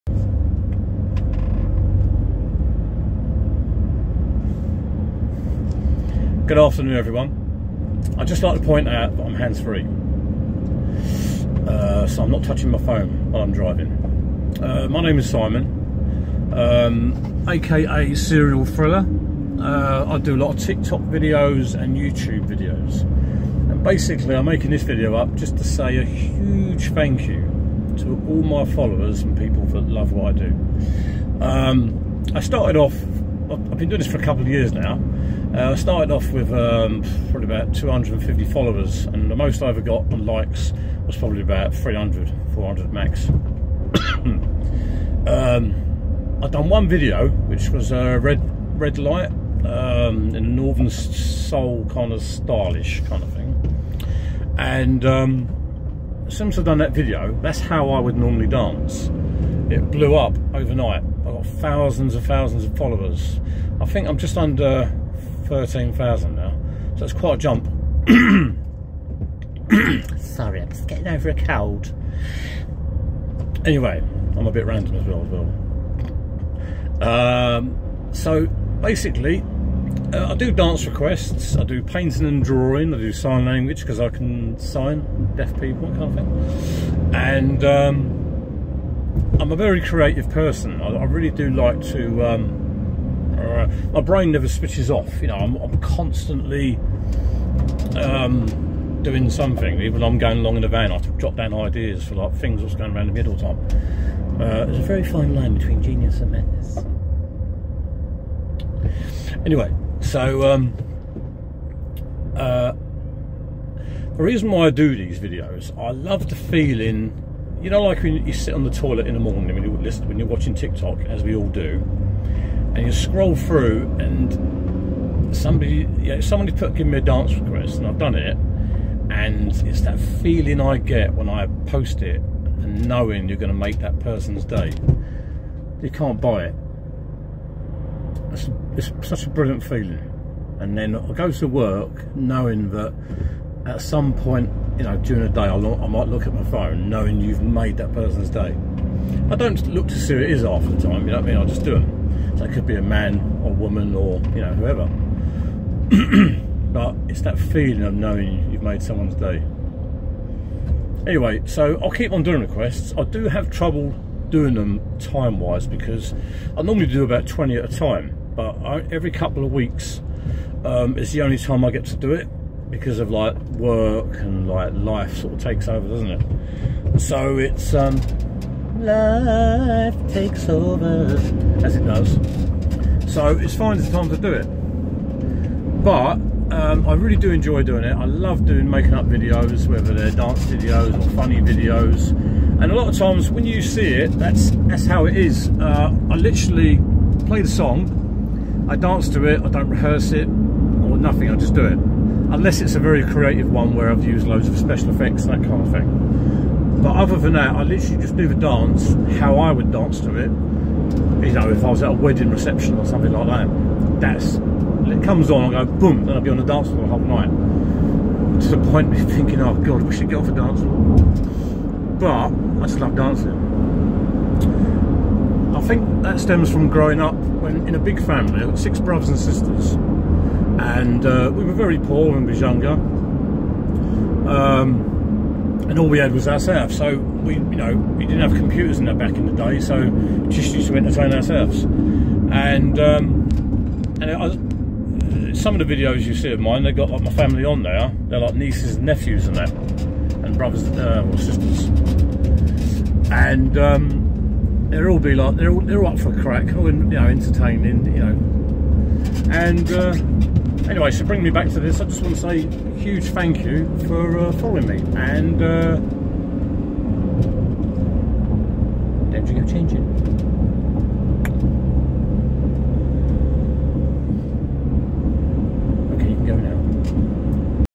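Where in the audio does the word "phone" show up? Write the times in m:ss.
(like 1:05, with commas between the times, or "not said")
0:12, 2:26.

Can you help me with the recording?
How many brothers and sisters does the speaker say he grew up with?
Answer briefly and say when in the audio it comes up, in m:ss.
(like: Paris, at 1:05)
6, at 3:48.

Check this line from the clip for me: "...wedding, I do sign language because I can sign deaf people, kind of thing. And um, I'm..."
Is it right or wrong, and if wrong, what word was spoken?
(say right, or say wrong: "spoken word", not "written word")
wrong: "drawing", not "wedding".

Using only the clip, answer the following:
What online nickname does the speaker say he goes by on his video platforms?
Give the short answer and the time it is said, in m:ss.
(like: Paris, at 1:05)
Serial Thriller, at 0:18.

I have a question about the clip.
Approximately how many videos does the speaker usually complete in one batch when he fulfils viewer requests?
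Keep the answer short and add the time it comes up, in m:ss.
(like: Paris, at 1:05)
20, at 2:47.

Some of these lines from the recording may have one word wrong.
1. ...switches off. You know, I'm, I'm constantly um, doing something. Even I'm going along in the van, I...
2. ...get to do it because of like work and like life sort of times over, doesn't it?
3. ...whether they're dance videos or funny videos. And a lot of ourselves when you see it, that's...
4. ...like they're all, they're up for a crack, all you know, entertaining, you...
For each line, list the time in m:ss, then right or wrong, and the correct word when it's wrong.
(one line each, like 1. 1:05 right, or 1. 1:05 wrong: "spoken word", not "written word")
1. 1:34 right
2. 2:51 wrong: "takes", not "times"
3. 3:09 wrong: "times", not "ourselves"
4. 4:15 right.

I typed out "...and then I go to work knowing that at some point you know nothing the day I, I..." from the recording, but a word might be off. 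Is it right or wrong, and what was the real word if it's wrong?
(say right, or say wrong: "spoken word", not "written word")
wrong: "during", not "nothing".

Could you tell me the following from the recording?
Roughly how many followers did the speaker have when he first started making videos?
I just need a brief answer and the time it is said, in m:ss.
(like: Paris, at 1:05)
250, at 0:37.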